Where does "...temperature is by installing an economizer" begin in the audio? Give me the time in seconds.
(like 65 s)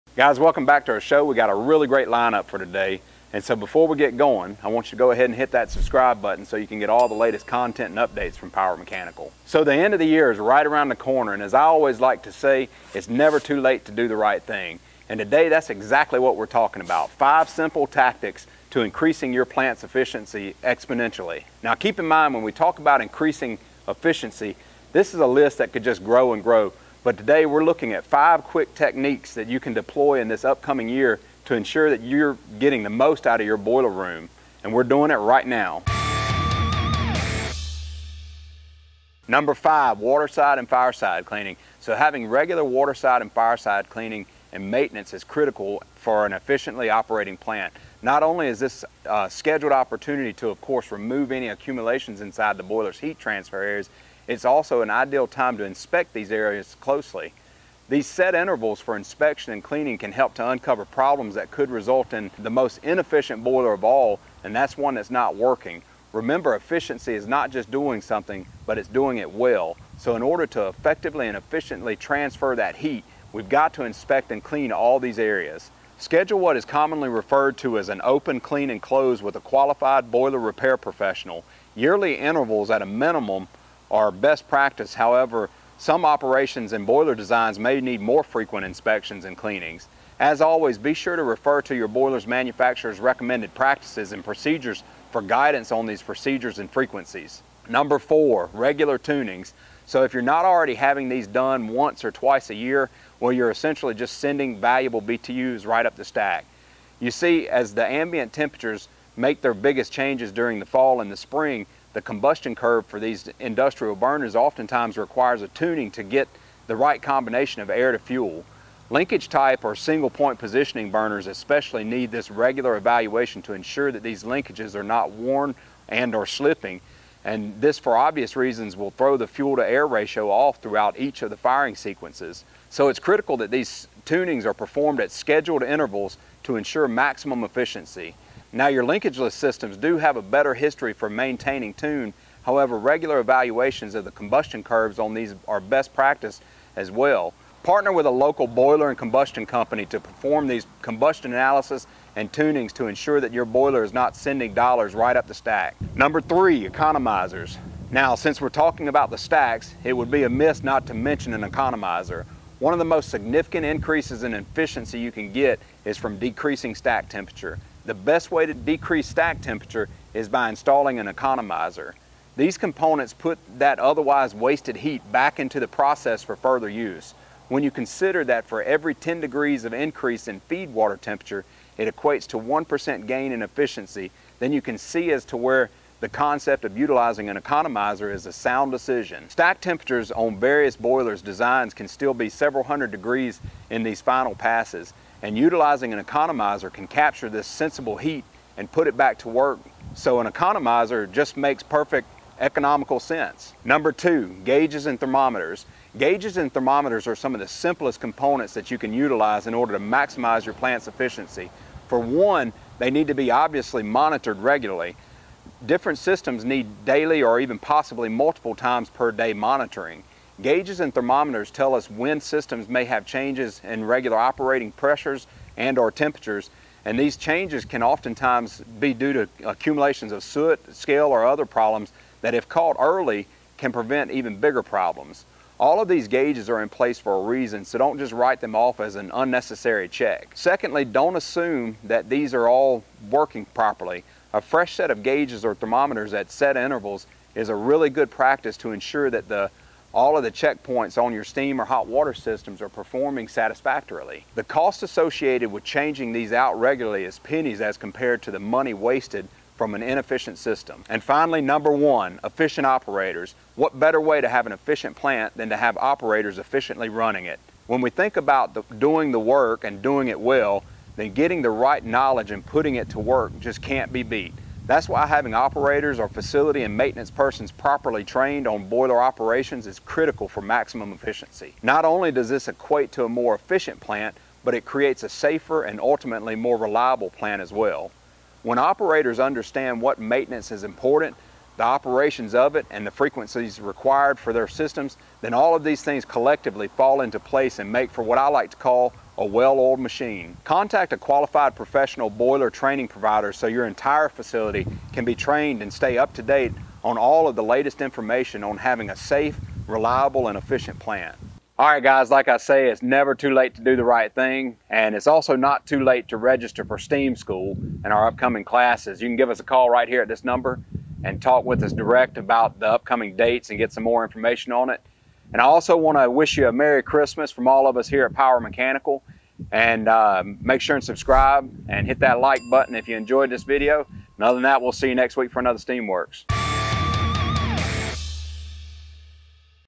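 169 s.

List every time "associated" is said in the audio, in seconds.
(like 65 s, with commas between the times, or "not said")
254 s.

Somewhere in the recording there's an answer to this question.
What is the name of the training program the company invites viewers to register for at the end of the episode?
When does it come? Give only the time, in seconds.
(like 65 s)
316 s.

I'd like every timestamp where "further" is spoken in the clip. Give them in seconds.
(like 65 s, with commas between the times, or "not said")
176 s.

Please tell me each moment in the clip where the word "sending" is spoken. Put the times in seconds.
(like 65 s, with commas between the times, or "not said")
104 s, 154 s.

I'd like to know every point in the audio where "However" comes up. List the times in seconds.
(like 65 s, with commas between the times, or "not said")
84 s, 142 s.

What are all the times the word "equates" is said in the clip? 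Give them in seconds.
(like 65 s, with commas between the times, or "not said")
181 s, 282 s.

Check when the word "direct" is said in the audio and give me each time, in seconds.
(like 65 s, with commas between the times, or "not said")
321 s.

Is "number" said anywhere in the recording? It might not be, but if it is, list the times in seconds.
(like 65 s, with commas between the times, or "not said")
39 s, 97 s, 155 s, 203 s, 261 s, 320 s.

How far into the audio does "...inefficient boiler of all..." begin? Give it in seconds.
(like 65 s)
62 s.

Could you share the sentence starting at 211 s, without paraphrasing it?
For one, they need to be obviously monitored regularly.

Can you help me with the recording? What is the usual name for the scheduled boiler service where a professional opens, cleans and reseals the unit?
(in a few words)
open, clean, and close.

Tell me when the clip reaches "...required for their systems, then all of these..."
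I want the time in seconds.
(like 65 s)
293 s.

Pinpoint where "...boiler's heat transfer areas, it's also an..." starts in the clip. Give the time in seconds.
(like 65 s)
52 s.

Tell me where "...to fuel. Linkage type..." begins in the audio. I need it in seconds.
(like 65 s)
117 s.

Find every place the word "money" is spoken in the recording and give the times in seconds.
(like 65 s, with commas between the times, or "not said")
258 s.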